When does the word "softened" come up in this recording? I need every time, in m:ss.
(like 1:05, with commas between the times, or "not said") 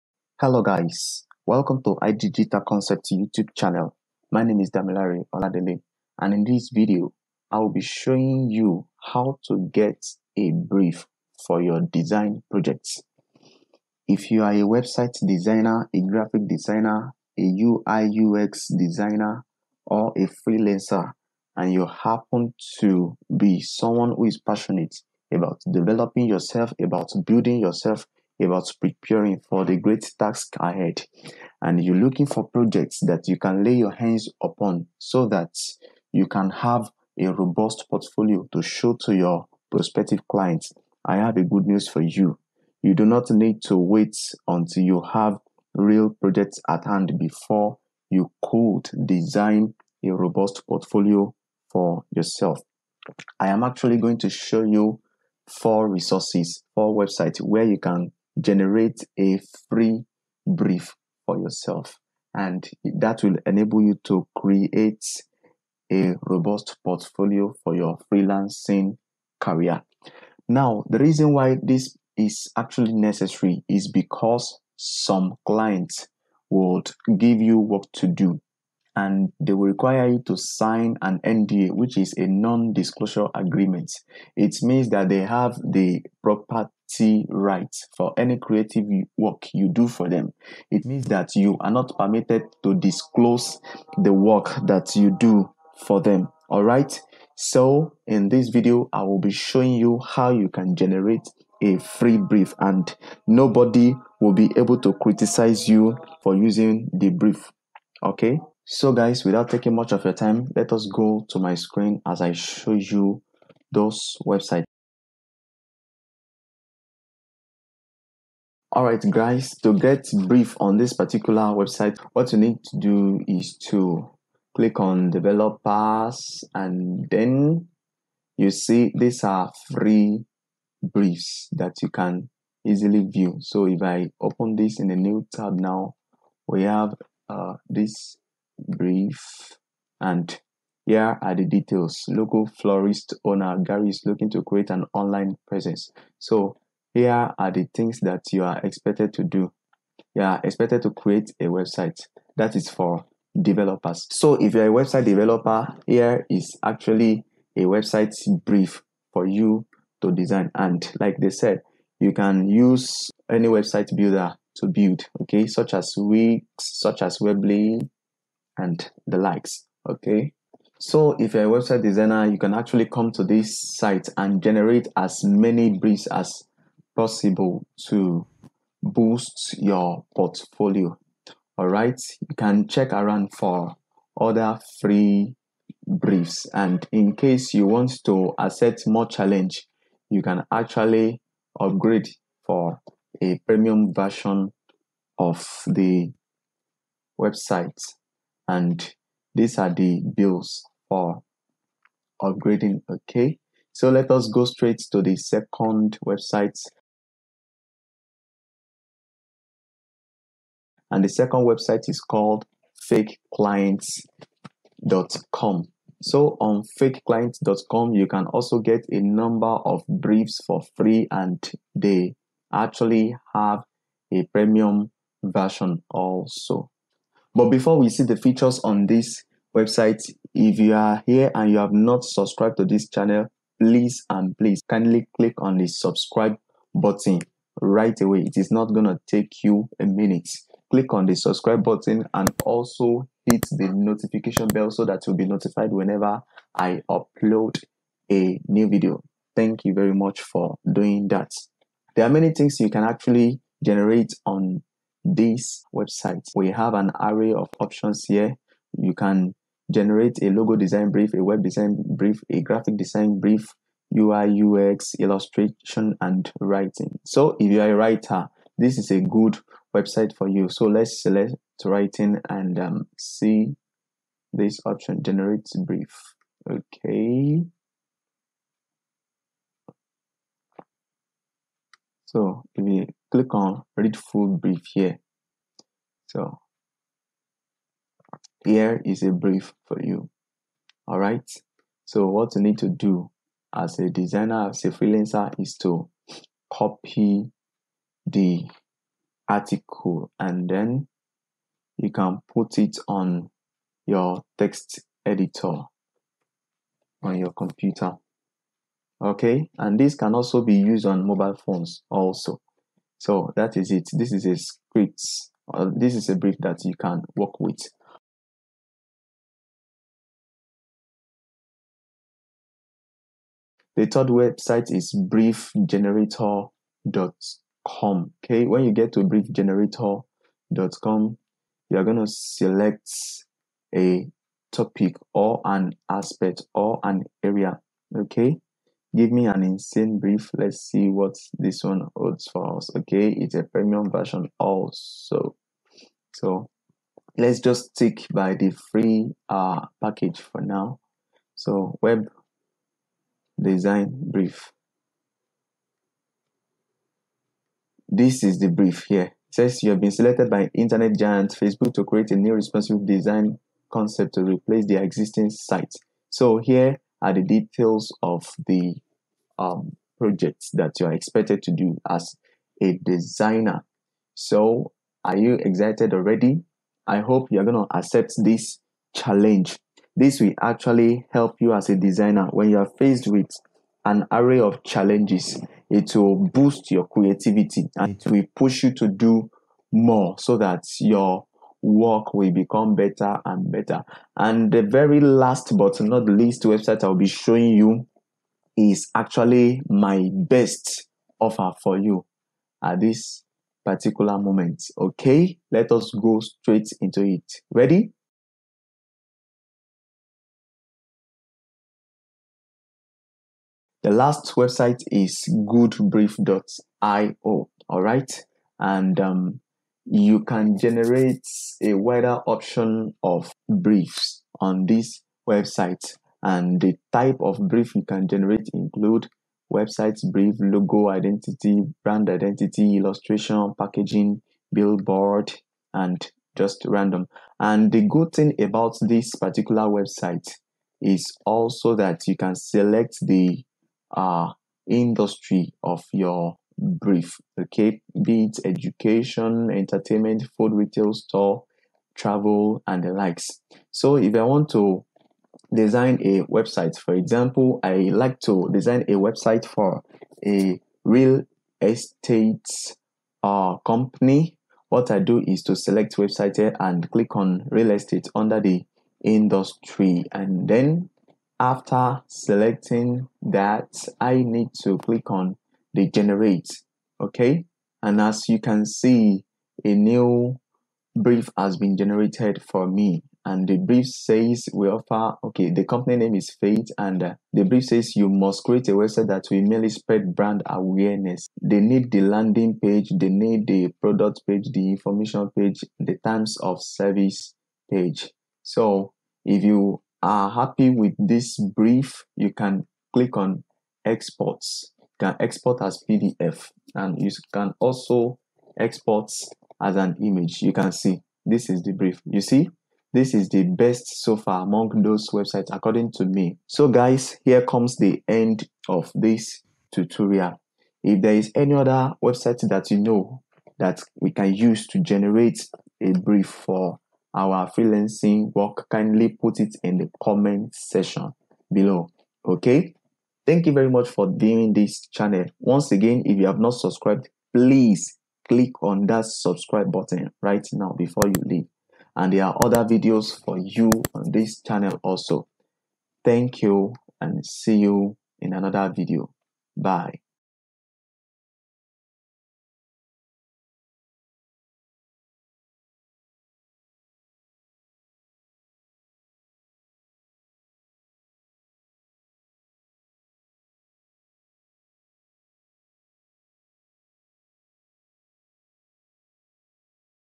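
not said.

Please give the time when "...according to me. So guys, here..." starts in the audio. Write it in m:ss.
8:35.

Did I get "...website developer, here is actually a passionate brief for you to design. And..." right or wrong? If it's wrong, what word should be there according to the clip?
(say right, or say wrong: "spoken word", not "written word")
wrong: "website", not "passionate".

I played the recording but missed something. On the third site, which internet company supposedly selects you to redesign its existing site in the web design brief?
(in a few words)
Facebook.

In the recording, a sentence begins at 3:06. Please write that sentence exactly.
And in case you want to accept more challenge, you can actually upgrade for a premium version of the website.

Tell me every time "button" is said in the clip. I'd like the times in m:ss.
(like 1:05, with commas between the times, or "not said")
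3:56, 4:01, 8:59.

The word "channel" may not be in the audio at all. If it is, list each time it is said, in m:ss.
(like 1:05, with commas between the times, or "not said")
0:03, 3:52, 8:54, 9:04.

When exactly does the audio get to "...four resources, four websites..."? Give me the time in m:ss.
0:55.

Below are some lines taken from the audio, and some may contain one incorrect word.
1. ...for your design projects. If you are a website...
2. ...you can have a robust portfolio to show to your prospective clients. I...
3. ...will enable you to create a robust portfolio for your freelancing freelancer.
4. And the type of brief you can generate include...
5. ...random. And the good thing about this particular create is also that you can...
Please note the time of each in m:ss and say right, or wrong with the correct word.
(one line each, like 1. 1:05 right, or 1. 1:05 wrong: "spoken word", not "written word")
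1. 0:11 right
2. 0:36 right
3. 1:03 wrong: "career", not "freelancer"
4. 7:06 right
5. 7:16 wrong: "website", not "create".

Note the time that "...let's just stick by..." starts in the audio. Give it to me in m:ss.
5:47.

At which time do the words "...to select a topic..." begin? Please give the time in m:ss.
5:32.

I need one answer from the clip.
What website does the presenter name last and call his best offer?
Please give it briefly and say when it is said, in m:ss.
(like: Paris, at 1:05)
goodbrief.io, at 6:55.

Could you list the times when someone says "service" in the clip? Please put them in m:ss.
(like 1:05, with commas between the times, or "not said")
8:16.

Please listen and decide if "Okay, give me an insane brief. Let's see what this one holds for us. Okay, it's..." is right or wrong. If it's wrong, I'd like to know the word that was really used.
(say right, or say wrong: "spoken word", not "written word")
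right.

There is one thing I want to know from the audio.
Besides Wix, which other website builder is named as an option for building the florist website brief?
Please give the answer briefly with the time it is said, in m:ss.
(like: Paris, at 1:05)
Weebly, at 2:47.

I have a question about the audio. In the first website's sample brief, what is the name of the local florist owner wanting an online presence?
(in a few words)
Gary.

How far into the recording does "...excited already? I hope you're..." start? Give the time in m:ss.
6:15.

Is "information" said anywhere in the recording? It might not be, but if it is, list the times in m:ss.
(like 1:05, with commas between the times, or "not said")
8:14.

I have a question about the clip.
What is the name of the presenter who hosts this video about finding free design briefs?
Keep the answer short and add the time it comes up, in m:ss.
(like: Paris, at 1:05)
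Damilare Oladele, at 0:04.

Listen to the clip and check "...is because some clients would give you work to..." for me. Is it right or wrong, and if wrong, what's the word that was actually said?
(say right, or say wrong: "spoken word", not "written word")
right.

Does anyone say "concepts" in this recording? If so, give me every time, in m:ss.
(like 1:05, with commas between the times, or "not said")
0:02, 6:03.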